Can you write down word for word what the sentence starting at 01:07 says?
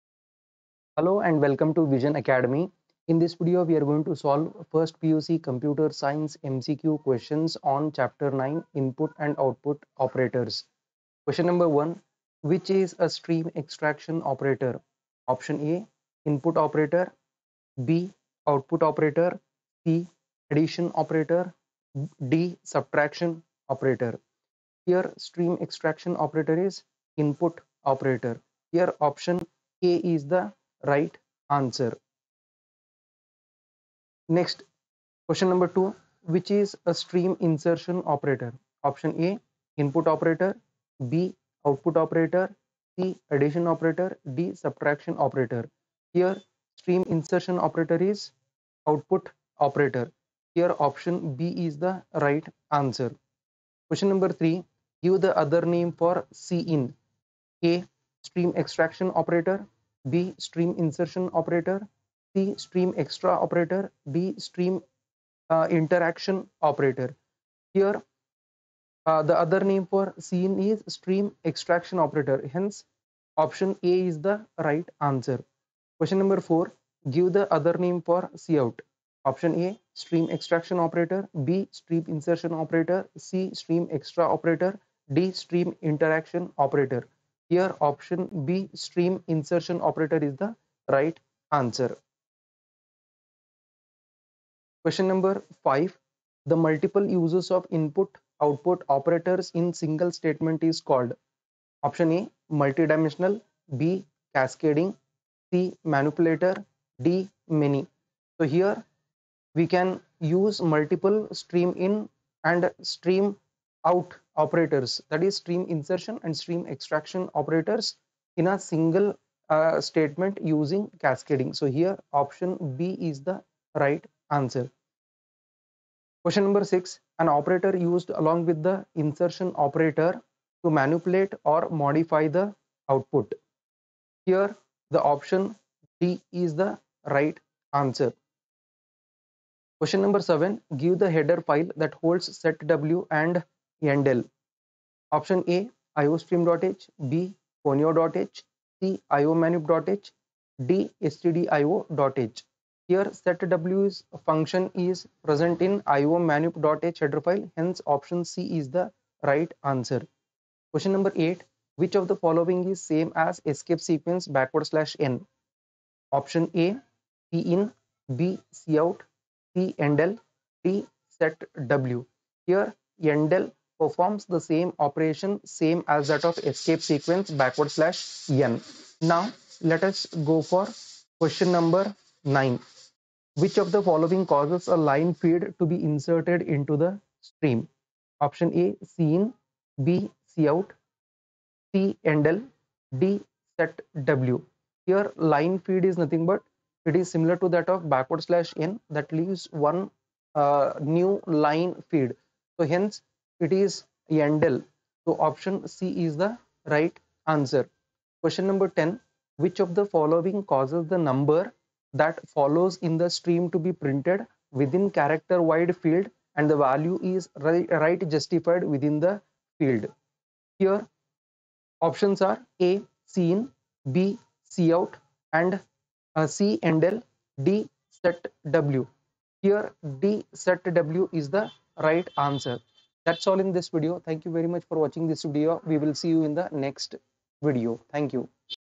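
Here uh, the other name for cin is stream extraction operator.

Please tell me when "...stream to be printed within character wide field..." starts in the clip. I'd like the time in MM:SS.
03:33.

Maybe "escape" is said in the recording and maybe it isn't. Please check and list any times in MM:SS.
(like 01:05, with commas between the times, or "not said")
02:43, 02:56.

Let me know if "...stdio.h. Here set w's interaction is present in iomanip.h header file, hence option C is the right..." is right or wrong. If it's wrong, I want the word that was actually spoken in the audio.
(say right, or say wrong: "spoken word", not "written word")
wrong: "function", not "interaction".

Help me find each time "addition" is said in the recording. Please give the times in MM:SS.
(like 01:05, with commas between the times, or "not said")
00:20, 00:43.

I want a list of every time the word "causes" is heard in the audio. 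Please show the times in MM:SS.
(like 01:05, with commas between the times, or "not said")
03:04, 03:30.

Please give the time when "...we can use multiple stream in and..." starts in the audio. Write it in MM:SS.
01:49.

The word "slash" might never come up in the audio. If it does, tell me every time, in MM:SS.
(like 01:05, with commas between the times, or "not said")
02:44, 02:57, 03:18.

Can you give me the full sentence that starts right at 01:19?
Option A stream extraction operator, B stream insertion operator, C stream extra operator, D stream interaction operator.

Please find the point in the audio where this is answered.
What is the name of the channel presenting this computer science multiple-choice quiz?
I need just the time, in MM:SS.
00:01.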